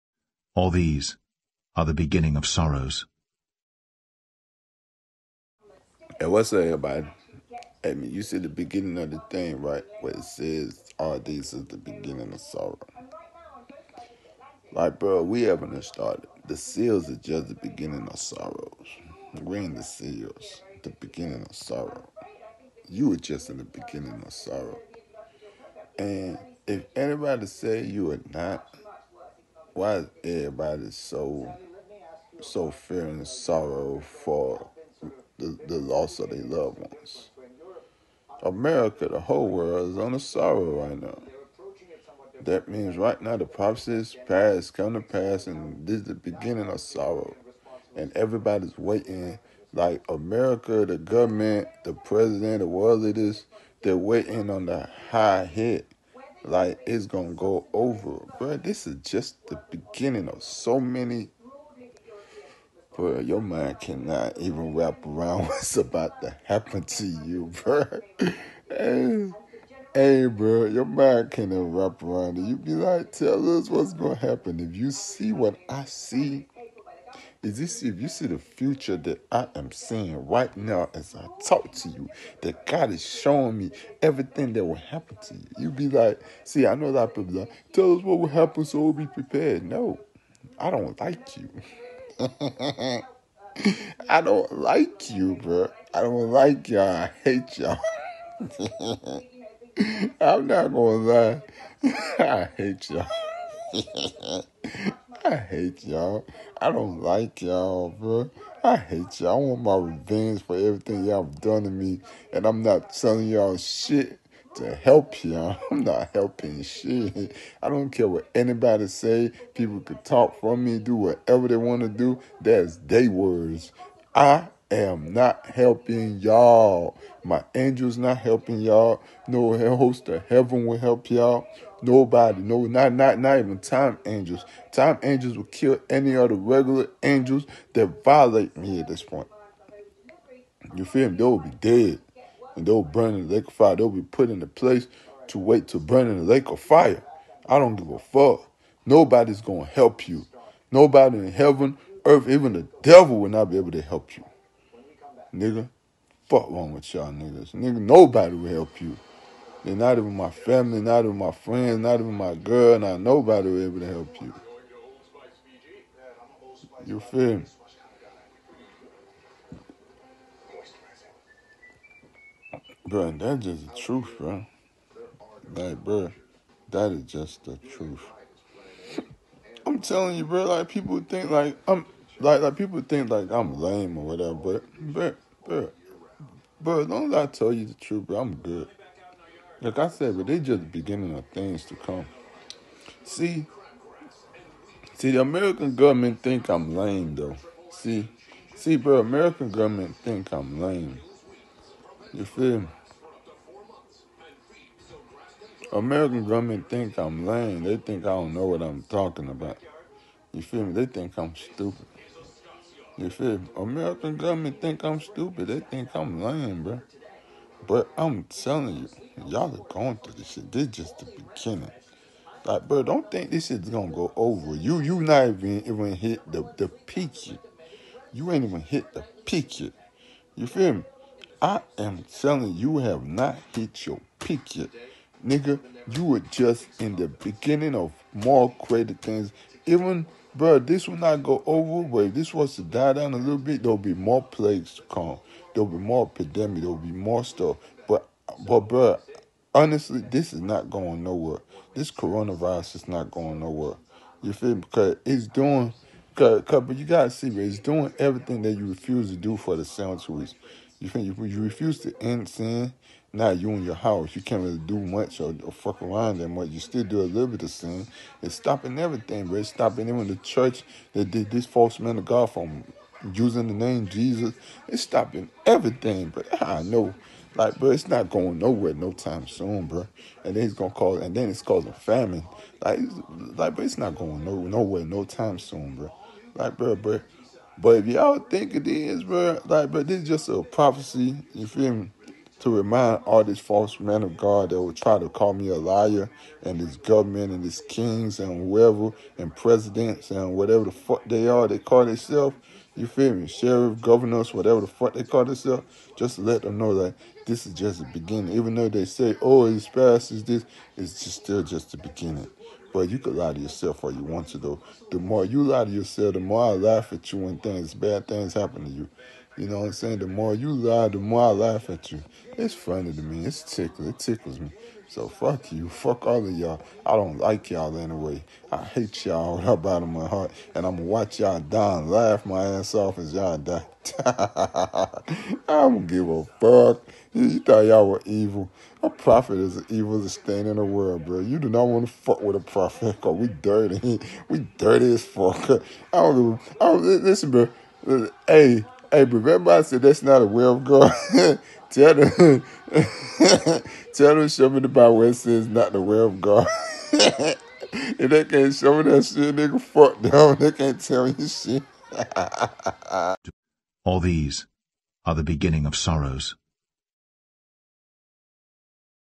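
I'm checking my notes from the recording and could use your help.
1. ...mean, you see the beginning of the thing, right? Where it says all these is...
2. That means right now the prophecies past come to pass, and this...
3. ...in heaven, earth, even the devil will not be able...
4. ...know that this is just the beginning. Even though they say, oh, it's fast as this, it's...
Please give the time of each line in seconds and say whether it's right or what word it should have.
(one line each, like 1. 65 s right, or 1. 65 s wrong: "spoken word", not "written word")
1. 7 s right
2. 42 s right
3. 151 s right
4. 306 s right.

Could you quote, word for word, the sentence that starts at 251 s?
This coronavirus is not going nowhere.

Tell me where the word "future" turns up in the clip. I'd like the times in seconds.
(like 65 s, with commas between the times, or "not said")
78 s.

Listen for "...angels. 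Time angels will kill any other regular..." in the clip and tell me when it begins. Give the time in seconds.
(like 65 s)
134 s.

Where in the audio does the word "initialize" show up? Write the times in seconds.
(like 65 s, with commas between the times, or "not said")
not said.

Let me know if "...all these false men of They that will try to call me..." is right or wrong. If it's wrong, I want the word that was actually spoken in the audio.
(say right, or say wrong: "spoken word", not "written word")
wrong: "God", not "They".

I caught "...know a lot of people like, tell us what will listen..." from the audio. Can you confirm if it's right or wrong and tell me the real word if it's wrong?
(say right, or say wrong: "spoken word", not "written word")
wrong: "happen", not "listen".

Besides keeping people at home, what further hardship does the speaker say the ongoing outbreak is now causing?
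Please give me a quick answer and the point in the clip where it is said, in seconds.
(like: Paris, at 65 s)
famine, at 281 s.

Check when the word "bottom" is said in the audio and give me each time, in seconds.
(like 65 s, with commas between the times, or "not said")
329 s.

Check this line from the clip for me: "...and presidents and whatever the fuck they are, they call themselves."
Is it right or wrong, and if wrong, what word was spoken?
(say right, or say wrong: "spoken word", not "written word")
right.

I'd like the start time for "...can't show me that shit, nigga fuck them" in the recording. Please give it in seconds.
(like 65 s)
358 s.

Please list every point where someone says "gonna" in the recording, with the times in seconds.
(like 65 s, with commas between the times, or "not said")
57 s, 73 s, 100 s, 149 s, 223 s, 280 s.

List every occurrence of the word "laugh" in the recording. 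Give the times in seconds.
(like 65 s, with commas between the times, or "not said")
316 s, 321 s, 331 s.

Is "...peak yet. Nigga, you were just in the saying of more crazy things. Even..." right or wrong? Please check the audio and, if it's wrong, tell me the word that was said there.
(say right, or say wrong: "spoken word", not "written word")
wrong: "beginning", not "saying".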